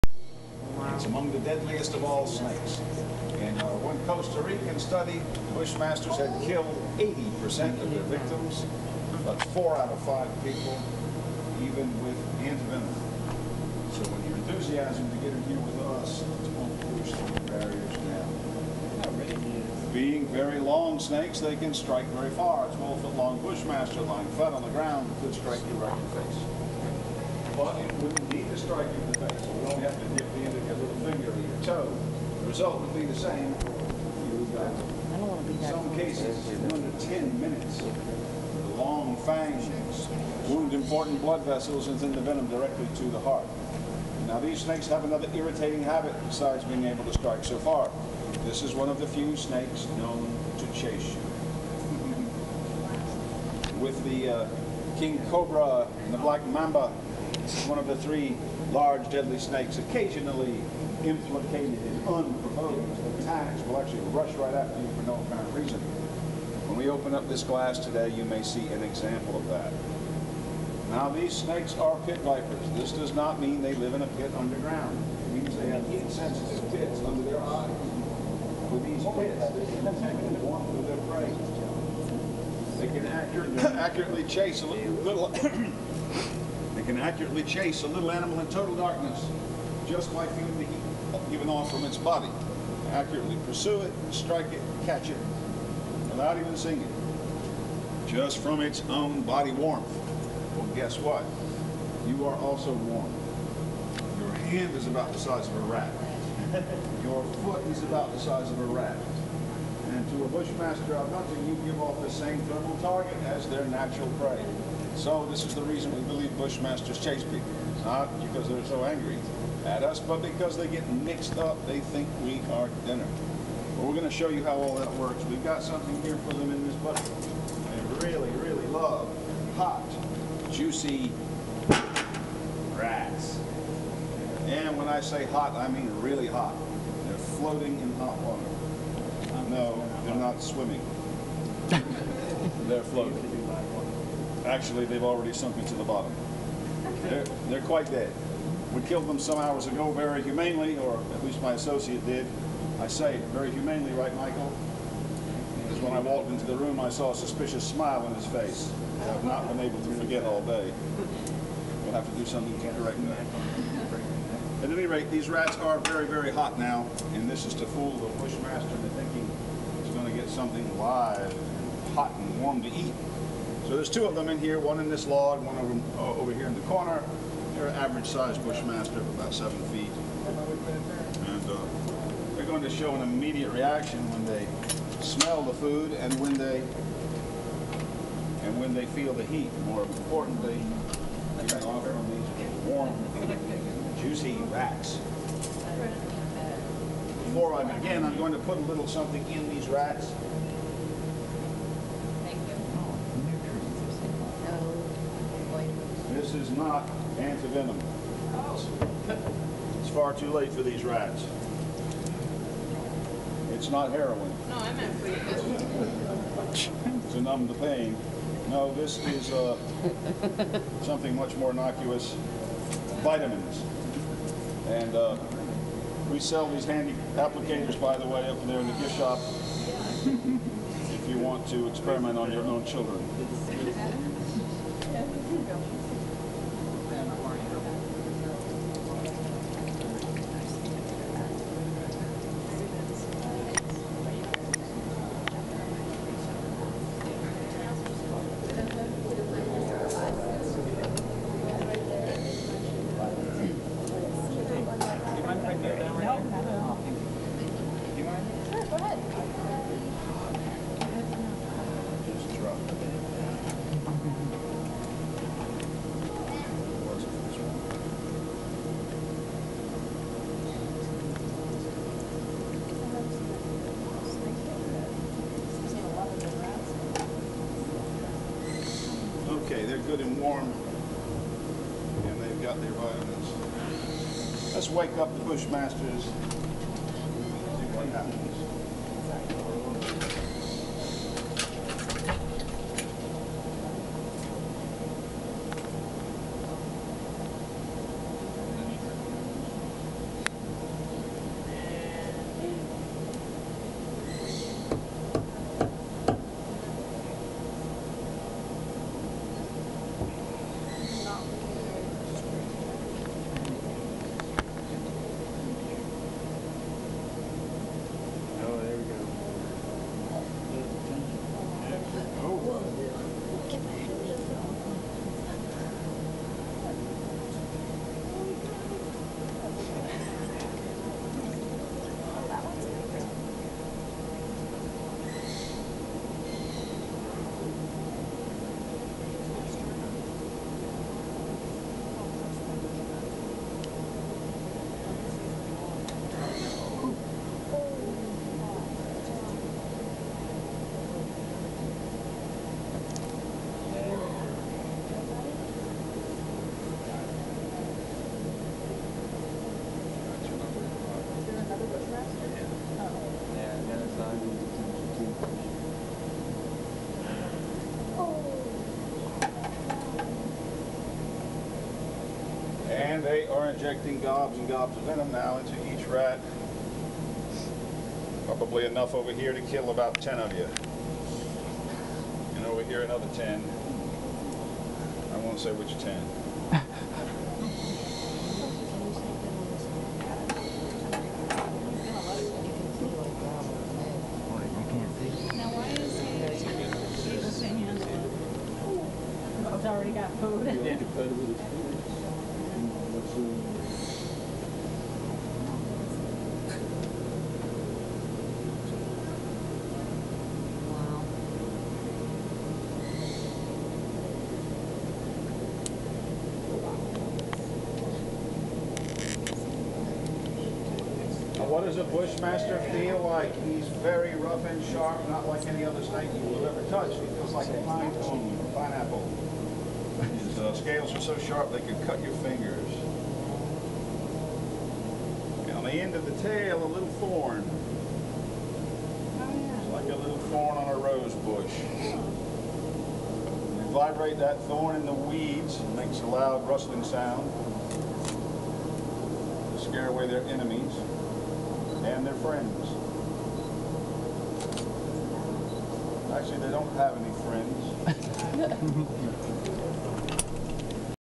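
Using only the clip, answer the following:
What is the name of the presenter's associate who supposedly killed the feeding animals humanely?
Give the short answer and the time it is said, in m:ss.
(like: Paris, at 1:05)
Michael, at 2:34.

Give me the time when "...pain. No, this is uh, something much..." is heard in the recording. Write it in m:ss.
3:37.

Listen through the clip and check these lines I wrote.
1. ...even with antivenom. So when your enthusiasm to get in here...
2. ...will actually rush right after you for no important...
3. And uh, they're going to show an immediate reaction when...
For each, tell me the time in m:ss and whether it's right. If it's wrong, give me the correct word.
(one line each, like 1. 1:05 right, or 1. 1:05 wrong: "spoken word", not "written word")
1. 0:11 right
2. 1:03 wrong: "apparent", not "important"
3. 3:00 right.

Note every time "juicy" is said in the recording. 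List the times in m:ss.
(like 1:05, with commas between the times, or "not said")
2:10, 3:14.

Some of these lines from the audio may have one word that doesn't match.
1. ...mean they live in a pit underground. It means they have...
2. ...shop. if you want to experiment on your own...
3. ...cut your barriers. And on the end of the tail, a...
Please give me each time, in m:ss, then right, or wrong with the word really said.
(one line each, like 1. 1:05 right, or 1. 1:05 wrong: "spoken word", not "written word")
1. 1:13 right
2. 3:48 right
3. 7:11 wrong: "fingers", not "barriers".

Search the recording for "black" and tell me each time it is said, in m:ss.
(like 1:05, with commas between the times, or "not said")
0:56.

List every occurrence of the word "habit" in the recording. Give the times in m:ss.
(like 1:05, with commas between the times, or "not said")
0:45.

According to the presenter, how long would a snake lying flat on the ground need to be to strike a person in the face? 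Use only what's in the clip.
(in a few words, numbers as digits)
12 feet.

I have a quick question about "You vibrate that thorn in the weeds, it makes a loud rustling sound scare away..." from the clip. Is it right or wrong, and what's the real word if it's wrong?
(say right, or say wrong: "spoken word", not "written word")
right.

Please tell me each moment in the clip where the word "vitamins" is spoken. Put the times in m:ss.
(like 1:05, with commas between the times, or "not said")
3:43, 4:42.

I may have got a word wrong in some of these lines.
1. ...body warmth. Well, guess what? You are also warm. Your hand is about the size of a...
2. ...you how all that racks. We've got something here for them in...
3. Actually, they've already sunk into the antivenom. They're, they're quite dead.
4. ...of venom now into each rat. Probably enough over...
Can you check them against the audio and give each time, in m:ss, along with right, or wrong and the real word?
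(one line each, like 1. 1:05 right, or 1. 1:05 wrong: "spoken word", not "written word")
1. 1:39 right
2. 2:04 wrong: "works", not "racks"
3. 2:24 wrong: "bottom", not "antivenom"
4. 6:14 right.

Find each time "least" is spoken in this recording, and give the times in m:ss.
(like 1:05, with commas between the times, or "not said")
2:31.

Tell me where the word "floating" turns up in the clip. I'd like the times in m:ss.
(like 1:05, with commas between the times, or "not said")
2:17, 2:22.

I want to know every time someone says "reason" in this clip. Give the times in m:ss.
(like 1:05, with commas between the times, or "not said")
1:05, 1:55.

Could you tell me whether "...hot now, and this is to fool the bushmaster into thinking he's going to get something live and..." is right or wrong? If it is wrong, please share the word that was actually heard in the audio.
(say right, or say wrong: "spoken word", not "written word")
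right.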